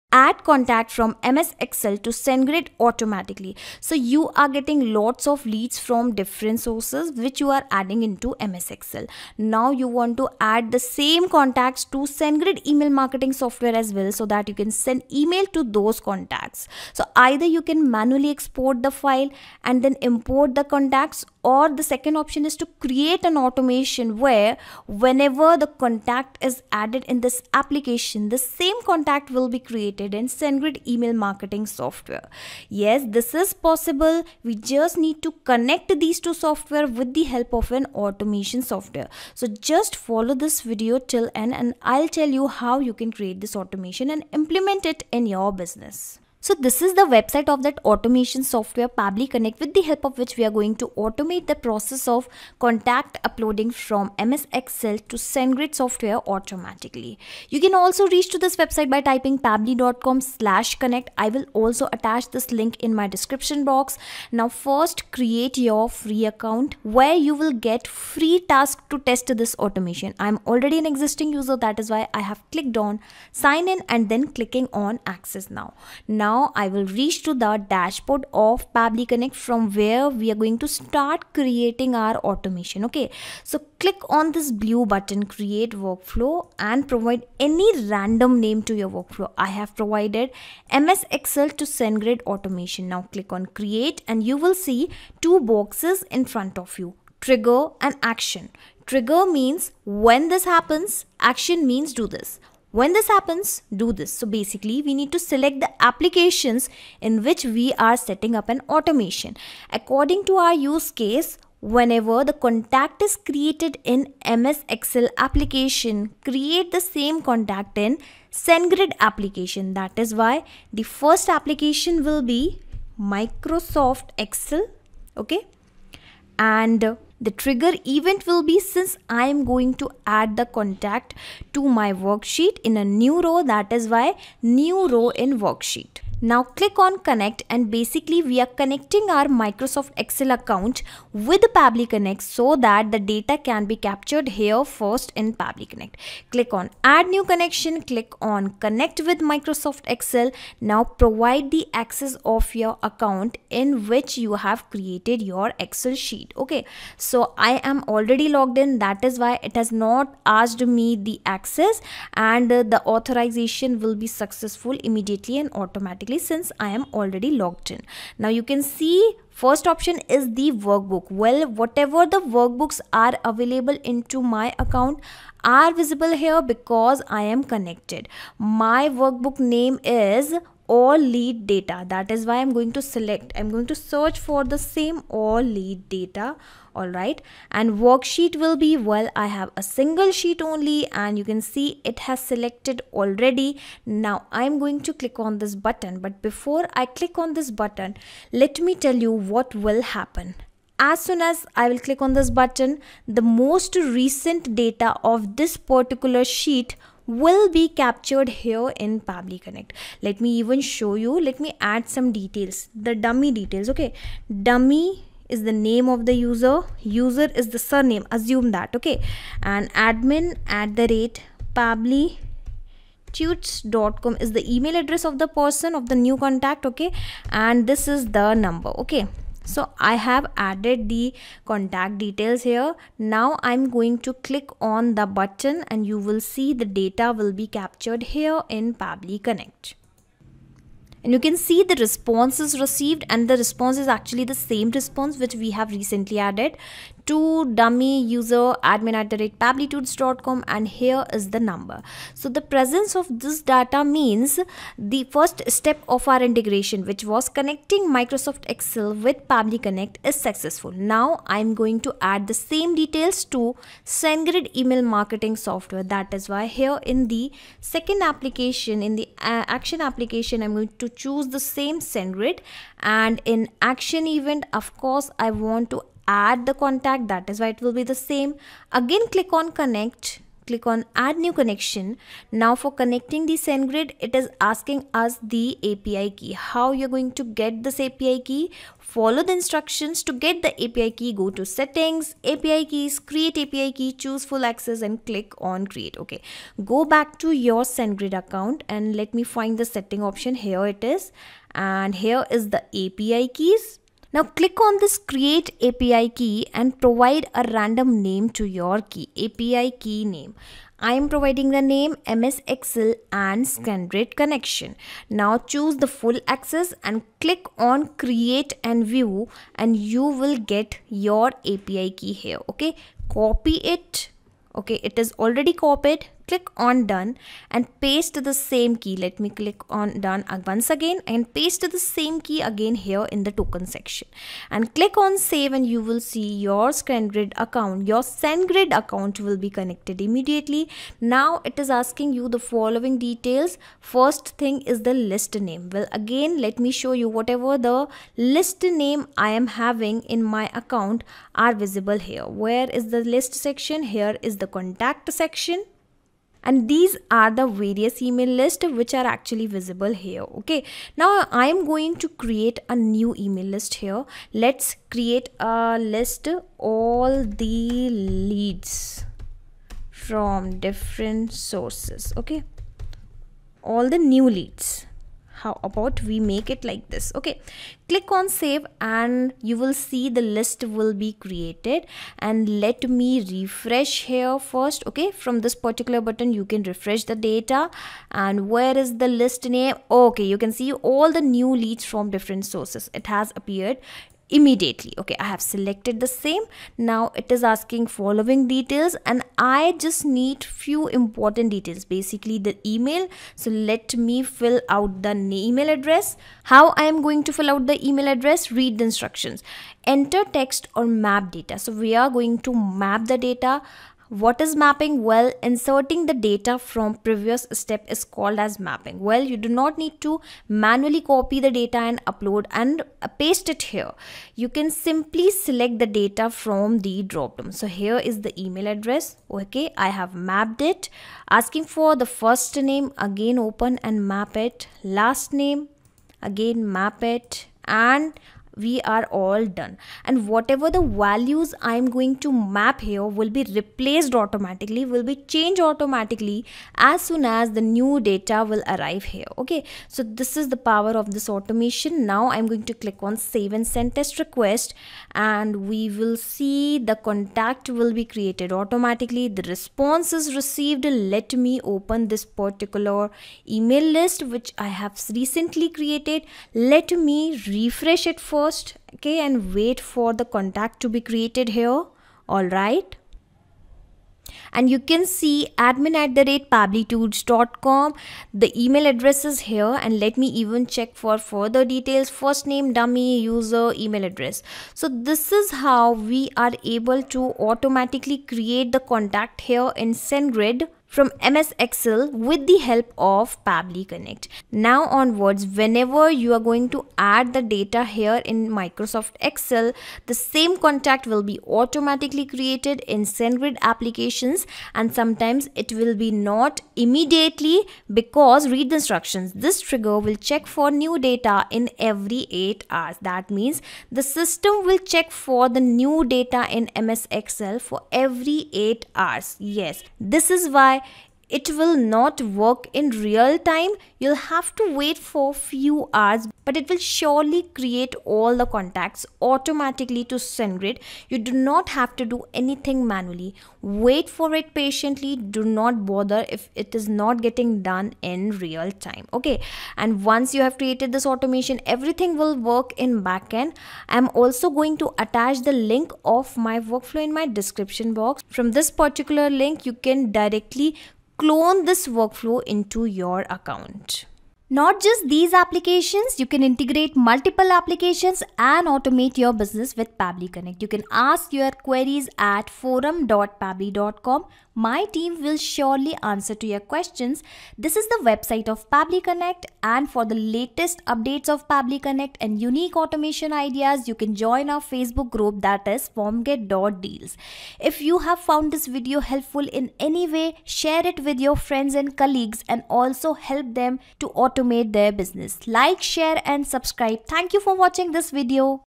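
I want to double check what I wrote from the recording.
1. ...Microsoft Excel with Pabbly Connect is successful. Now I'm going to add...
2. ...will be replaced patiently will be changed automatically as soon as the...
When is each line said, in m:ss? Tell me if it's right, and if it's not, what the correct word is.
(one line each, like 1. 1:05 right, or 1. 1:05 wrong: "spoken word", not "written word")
1. 4:17 right
2. 7:23 wrong: "automatically", not "patiently".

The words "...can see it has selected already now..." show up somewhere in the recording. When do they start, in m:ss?
3:11.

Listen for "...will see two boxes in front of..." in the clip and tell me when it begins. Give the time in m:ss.
1:34.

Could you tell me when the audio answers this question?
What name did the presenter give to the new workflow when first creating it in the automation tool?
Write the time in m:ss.
1:30.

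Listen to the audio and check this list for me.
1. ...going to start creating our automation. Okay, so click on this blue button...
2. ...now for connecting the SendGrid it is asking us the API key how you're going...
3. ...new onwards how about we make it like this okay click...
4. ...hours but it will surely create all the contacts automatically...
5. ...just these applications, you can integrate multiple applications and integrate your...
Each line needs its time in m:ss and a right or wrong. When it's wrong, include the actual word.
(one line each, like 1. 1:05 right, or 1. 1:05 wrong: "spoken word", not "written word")
1. 1:20 right
2. 4:42 right
3. 6:13 wrong: "leads", not "onwards"
4. 8:45 right
5. 9:14 wrong: "automate", not "integrate".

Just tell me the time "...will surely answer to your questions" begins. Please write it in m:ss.
9:25.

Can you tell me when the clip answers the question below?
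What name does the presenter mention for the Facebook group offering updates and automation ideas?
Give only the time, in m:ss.
9:35.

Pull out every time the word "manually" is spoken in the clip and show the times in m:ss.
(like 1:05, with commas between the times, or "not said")
0:17, 7:00, 8:52.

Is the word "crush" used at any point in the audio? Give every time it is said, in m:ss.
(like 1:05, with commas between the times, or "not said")
not said.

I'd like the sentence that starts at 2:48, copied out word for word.
Now you can see first option is the workbook.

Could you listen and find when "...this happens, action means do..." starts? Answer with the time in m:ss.
1:40.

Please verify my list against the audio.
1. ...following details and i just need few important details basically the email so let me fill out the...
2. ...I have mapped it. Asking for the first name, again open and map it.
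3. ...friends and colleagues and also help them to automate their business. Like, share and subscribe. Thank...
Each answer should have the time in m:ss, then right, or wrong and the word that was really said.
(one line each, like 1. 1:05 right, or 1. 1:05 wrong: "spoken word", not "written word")
1. 6:37 right
2. 7:09 right
3. 9:41 right.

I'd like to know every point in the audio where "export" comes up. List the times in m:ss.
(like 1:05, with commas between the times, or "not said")
0:18.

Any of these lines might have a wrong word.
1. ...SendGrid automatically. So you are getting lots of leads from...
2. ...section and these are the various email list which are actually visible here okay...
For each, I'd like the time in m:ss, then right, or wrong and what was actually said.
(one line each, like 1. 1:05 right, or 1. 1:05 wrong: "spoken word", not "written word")
1. 0:02 right
2. 5:55 right.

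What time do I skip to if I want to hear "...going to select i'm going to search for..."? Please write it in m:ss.
3:02.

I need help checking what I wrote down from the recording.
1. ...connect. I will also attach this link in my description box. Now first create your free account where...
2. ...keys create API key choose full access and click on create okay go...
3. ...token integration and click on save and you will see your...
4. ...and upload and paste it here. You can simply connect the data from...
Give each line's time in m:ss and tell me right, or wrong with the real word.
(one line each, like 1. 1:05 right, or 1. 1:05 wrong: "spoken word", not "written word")
1. 1:00 right
2. 4:52 right
3. 5:33 wrong: "section", not "integration"
4. 7:01 wrong: "select", not "connect".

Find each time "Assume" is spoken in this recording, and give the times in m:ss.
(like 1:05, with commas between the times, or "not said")
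3:38.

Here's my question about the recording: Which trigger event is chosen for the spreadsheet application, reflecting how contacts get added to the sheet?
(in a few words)
New row in worksheet.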